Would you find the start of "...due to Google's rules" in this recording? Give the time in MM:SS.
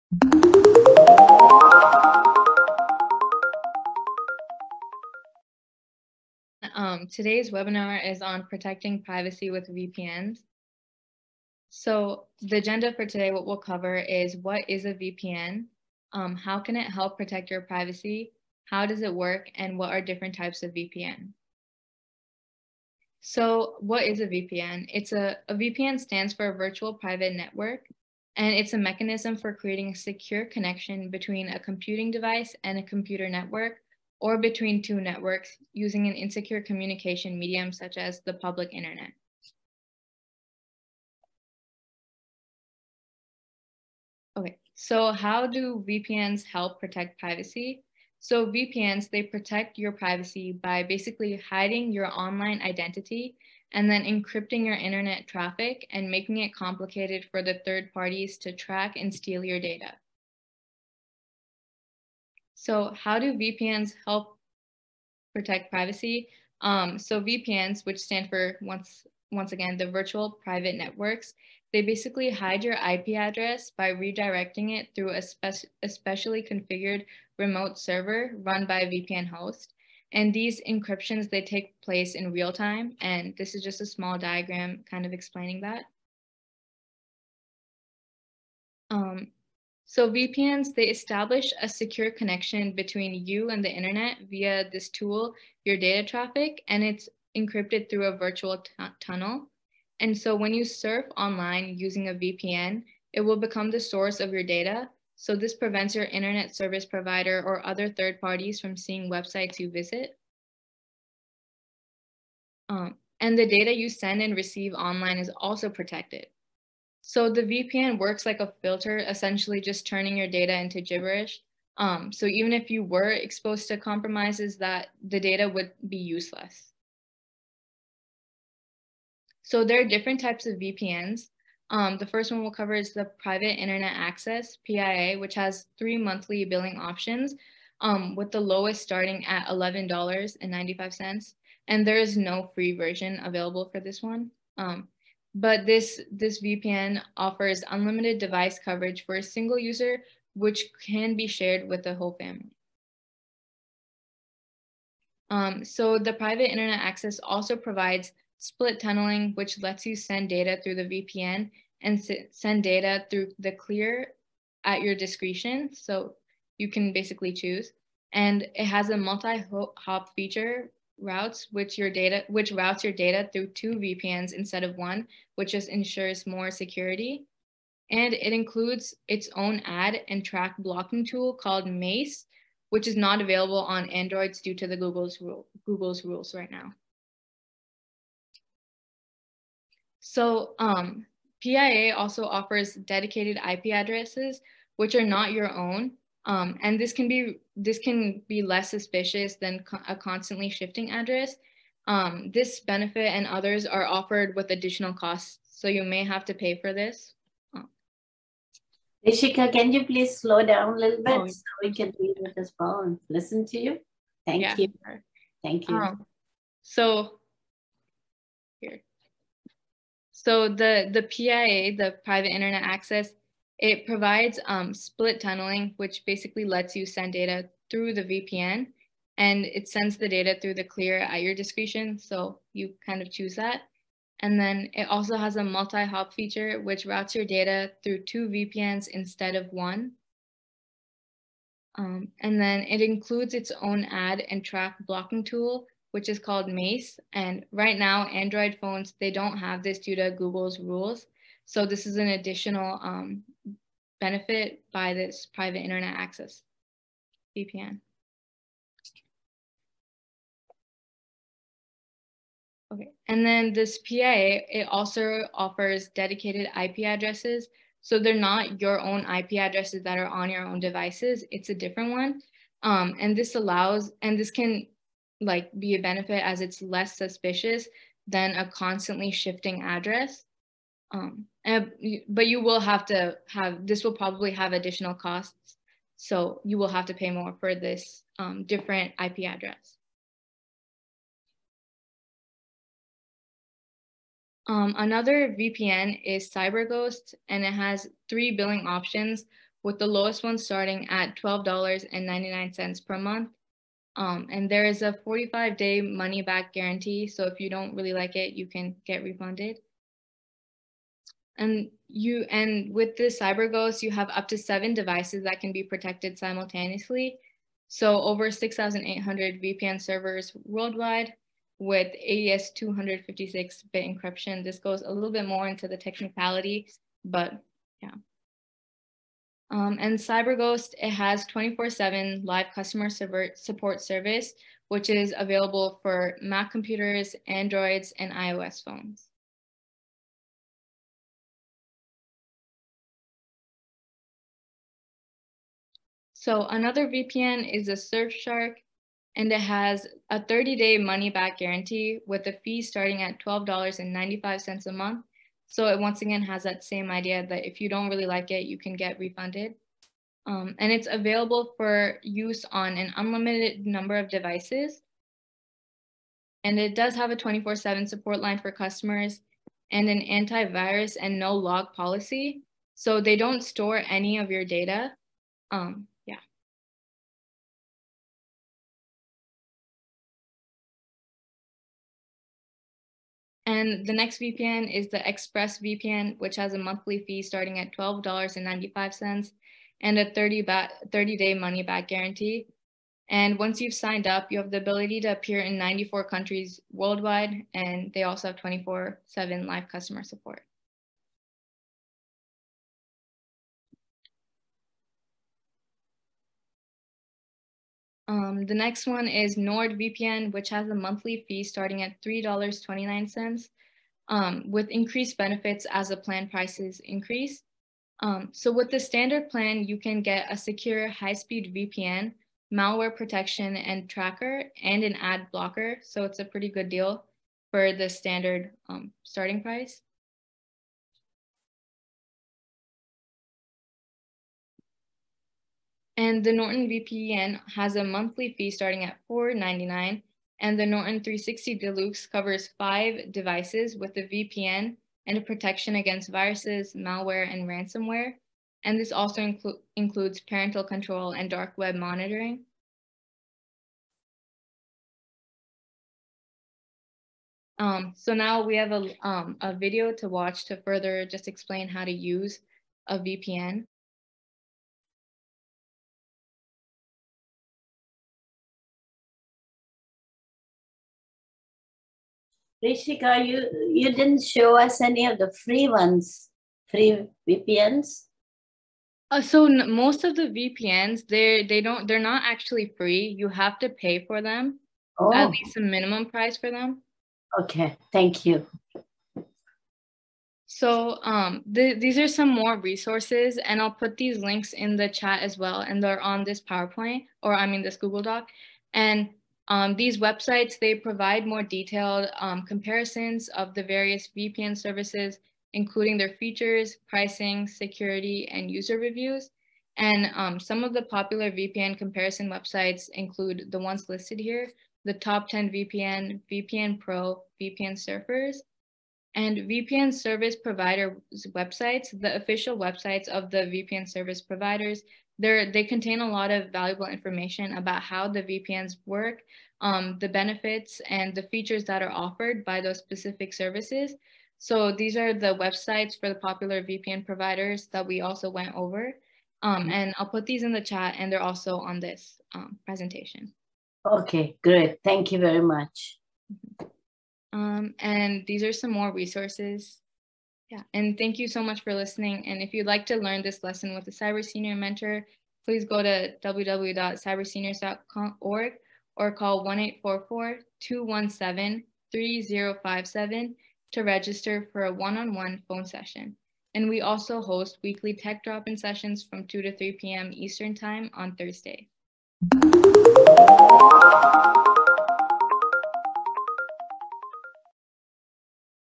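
04:09.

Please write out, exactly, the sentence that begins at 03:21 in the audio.
Um, this benefit and others are offered with additional costs, so you may have to pay for this.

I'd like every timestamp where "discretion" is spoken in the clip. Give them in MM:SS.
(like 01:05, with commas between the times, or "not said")
02:44, 03:51.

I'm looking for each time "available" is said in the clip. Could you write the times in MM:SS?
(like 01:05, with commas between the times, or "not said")
02:23, 03:03, 05:35, 06:00.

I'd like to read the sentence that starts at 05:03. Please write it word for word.
Um, and there is a 45 day money back guarantee.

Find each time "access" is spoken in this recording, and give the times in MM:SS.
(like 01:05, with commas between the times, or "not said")
02:13, 02:36, 03:42, 04:15.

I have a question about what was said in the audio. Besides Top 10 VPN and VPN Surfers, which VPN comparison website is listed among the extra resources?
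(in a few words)
VPN Pro.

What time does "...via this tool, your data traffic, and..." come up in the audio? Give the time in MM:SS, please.
01:34.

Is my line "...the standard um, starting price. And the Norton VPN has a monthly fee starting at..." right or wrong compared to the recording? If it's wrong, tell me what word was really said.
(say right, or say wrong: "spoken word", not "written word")
right.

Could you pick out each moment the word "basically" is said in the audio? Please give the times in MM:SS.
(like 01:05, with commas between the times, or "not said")
00:50, 01:11, 02:46, 03:46.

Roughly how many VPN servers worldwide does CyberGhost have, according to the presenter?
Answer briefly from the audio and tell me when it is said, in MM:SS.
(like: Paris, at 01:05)
6,800, at 05:18.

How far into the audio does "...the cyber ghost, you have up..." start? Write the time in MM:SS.
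05:12.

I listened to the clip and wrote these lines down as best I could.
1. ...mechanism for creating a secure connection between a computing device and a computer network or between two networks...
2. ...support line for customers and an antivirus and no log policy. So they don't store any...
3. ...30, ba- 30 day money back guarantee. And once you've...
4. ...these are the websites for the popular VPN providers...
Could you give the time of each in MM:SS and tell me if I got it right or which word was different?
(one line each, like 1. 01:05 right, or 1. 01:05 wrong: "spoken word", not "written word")
1. 00:28 right
2. 06:07 right
3. 06:30 right
4. 08:54 right.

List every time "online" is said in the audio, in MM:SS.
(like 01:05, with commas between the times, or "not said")
00:52, 01:41, 01:54.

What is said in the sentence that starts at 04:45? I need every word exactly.
So you will have to pay more for this um, different IP address.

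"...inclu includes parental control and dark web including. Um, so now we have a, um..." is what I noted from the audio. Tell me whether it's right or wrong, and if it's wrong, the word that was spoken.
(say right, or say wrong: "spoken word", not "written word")
wrong: "monitoring", not "including".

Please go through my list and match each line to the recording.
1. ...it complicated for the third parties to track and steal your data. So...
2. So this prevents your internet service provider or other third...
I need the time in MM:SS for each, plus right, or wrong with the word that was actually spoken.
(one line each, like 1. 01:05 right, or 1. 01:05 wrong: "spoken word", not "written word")
1. 00:56 right
2. 01:45 right.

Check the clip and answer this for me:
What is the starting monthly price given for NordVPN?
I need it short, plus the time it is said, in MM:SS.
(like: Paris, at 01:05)
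$3.29, at 06:52.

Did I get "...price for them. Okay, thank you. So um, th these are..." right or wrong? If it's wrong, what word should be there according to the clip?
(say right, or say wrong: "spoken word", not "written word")
right.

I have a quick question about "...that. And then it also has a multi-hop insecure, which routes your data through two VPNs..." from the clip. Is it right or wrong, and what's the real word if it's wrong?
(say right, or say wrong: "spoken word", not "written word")
wrong: "feature", not "insecure".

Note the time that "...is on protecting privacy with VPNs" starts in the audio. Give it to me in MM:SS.
00:08.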